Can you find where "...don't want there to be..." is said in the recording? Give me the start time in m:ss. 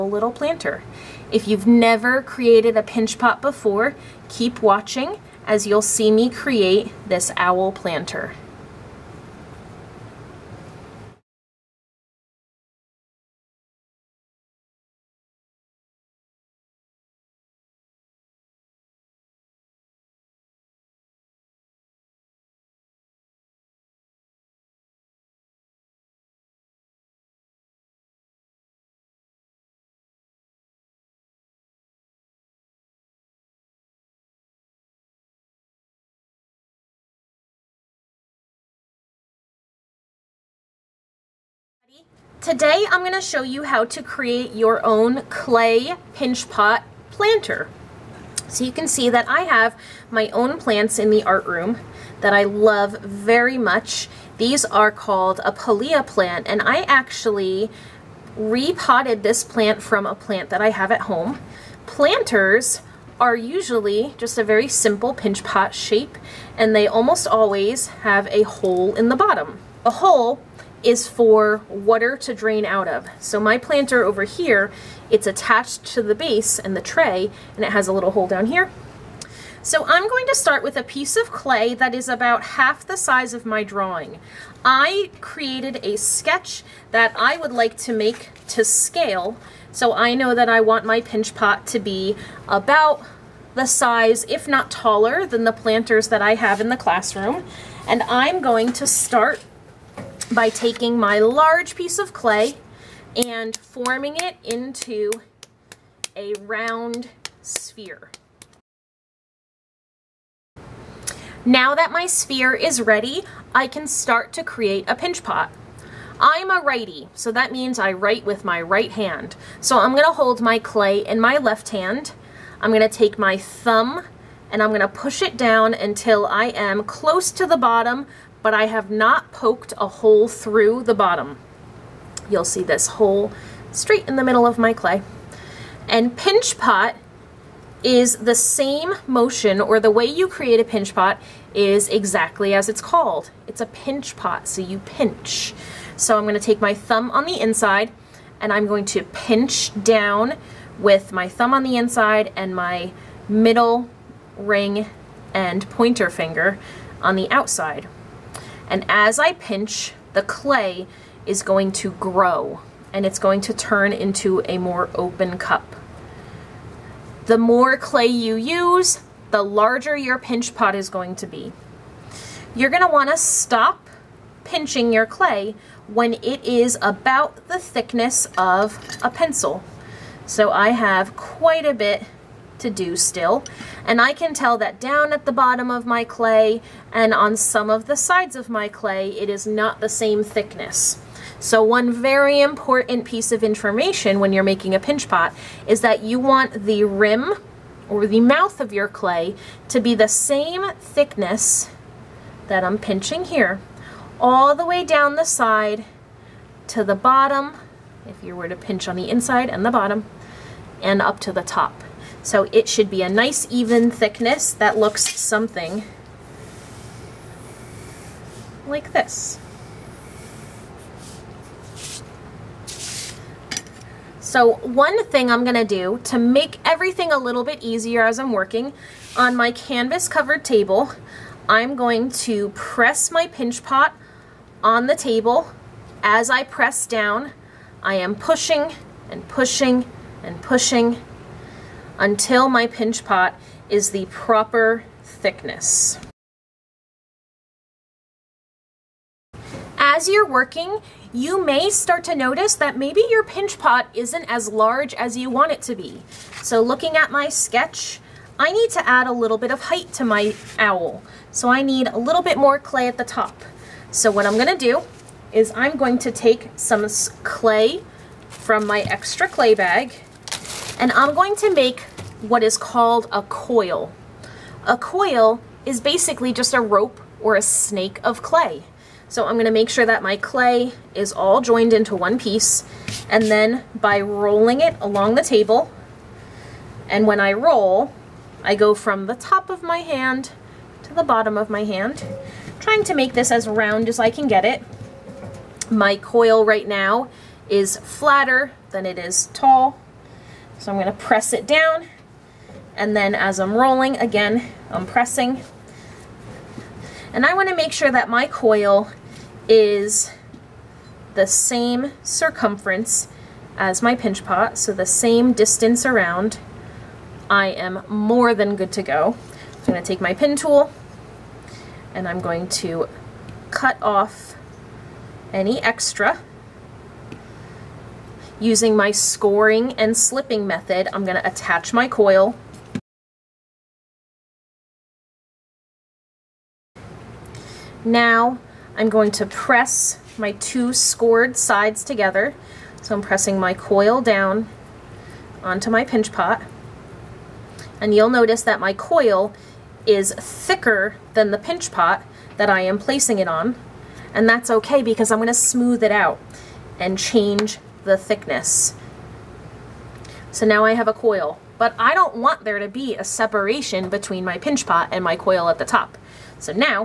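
6:01.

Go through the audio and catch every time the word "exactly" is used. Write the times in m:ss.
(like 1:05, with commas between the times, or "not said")
2:21.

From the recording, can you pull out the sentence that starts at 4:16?
So looking at my sketch, I need to add a little bit of height to my owl.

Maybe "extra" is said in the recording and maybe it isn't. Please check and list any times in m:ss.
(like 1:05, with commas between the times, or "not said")
4:28, 5:25.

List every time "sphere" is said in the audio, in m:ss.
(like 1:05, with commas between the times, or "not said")
1:47, 1:52.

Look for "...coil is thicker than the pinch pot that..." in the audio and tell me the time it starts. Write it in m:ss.
5:48.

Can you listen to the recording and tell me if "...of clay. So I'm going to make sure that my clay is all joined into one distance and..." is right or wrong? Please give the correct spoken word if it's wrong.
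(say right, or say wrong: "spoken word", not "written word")
wrong: "piece", not "distance".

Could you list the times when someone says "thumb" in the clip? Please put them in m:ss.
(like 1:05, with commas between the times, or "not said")
2:03, 2:26, 2:31.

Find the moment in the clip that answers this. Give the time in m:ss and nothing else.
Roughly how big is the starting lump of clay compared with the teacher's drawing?
1:22.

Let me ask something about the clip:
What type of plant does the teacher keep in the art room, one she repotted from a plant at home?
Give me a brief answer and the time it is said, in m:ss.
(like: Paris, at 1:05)
Pilea, at 0:55.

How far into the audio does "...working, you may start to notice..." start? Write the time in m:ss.
4:10.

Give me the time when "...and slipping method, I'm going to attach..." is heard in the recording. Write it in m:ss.
5:29.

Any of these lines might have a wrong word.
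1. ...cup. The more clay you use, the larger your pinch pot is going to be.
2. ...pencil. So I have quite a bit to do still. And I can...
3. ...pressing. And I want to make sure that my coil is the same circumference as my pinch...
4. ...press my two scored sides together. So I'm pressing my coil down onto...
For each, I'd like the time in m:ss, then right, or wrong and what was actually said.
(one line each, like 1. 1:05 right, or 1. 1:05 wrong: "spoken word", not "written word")
1. 2:45 right
2. 2:59 right
3. 5:04 right
4. 5:39 right.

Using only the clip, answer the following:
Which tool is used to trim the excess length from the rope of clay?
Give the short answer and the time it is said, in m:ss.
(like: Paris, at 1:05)
Pin tool, at 5:20.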